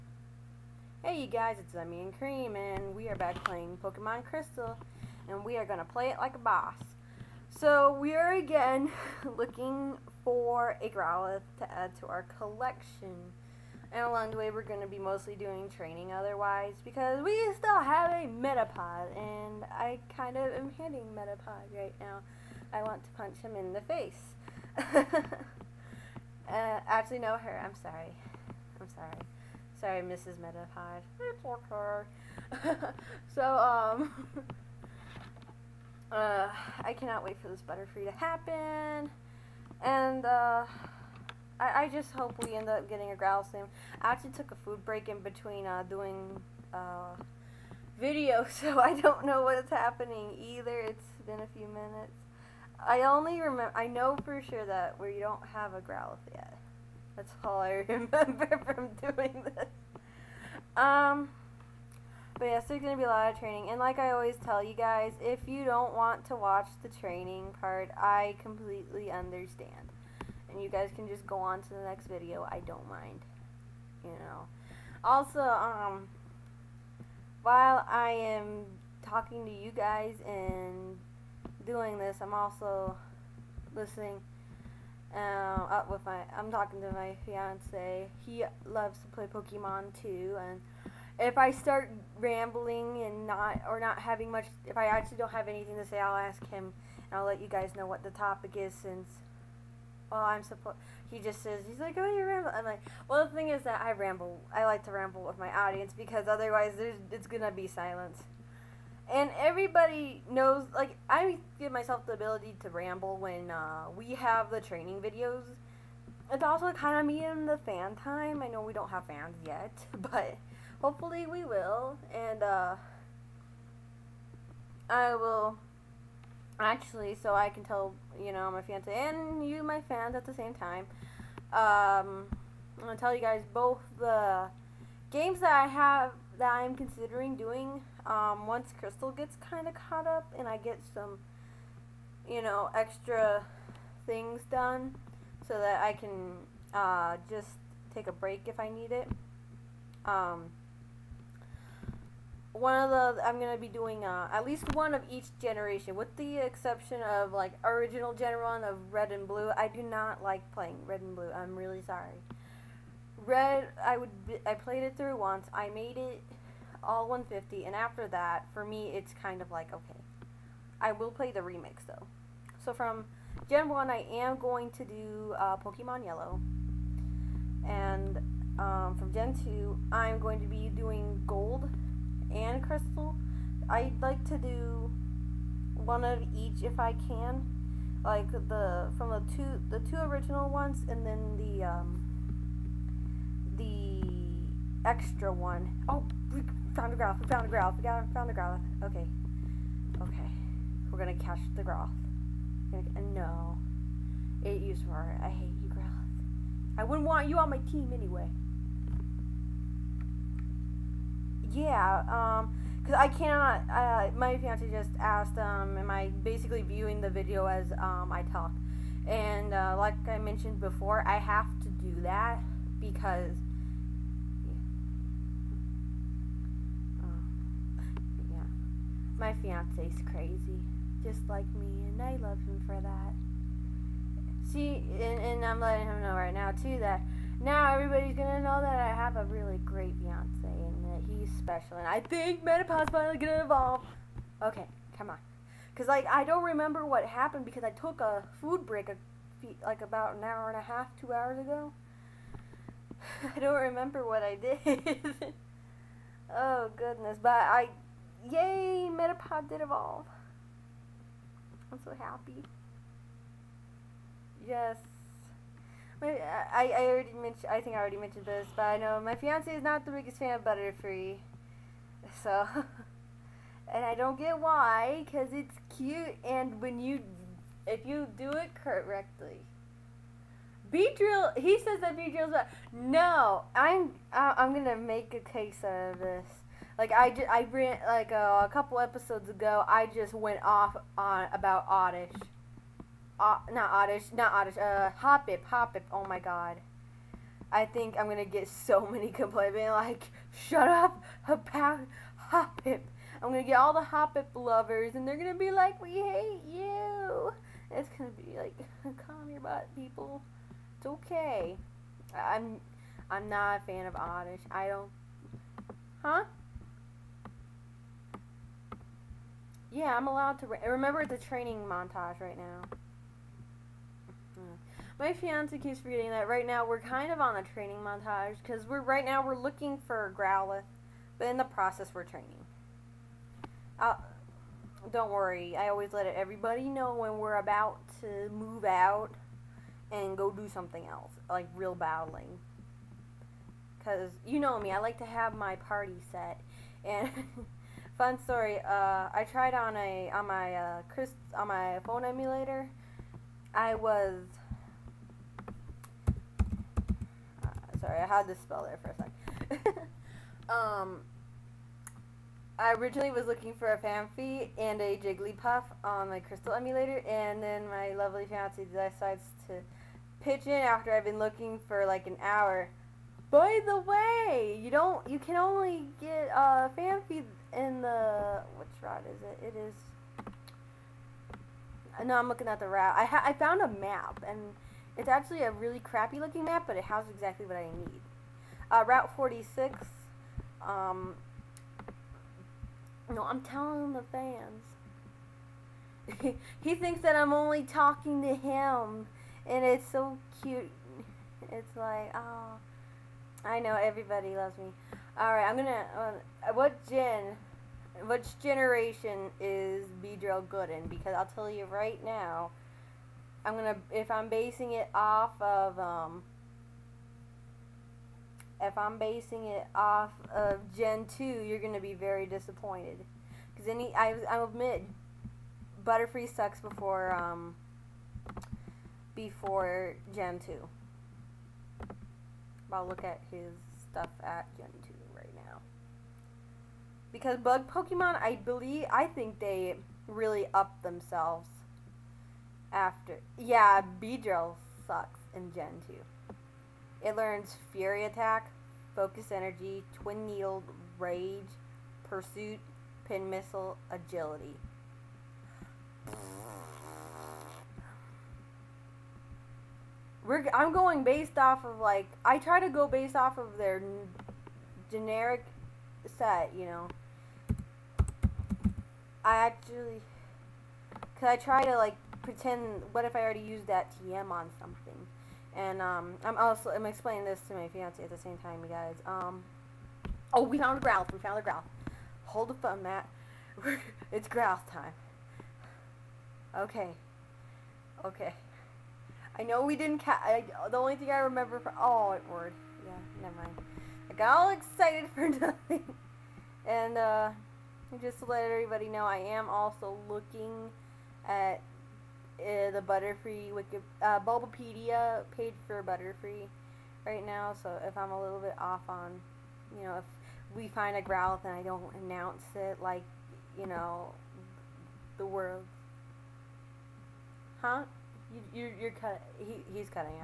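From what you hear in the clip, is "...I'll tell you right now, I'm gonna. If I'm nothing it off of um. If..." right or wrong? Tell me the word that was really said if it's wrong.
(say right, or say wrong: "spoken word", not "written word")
wrong: "basing", not "nothing".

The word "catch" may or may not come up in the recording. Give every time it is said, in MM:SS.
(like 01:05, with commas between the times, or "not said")
03:21, 08:09.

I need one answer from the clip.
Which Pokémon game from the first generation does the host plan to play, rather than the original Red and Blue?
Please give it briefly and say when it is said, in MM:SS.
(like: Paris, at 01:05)
Pokemon Yellow, at 02:55.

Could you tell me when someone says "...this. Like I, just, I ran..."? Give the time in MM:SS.
04:46.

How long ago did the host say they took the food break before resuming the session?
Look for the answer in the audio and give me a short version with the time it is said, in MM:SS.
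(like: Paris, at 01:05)
About an hour and a half, at 04:09.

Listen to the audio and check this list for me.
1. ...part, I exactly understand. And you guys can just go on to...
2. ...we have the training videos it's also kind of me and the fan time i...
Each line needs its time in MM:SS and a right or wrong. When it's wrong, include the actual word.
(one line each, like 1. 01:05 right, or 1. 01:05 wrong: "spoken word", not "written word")
1. 01:07 wrong: "completely", not "exactly"
2. 01:53 right.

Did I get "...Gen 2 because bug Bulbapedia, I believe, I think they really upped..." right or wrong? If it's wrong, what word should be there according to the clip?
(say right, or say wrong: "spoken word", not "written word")
wrong: "Pokemon", not "Bulbapedia".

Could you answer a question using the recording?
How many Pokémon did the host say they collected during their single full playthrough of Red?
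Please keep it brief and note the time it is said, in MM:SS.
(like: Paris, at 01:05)
150, at 02:47.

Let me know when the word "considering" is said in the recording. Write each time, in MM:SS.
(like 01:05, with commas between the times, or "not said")
02:16.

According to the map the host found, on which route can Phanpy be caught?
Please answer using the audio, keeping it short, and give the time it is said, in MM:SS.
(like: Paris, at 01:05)
Route 46, at 06:28.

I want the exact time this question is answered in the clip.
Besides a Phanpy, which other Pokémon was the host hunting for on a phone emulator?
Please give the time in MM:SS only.
06:04.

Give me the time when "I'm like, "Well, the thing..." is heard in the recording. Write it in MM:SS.
01:42.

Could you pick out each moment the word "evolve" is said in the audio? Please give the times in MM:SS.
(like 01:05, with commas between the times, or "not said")
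04:03, 04:19.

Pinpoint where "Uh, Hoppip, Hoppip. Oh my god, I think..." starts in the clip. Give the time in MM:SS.
04:54.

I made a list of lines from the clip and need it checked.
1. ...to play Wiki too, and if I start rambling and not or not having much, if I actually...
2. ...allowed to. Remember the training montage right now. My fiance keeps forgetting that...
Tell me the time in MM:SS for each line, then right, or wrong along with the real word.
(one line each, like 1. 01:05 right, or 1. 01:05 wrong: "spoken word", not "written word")
1. 01:29 wrong: "Pokemon", not "Wiki"
2. 05:20 right.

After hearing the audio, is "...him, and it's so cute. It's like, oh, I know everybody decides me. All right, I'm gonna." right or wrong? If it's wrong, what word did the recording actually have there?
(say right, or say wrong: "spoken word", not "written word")
wrong: "loves", not "decides".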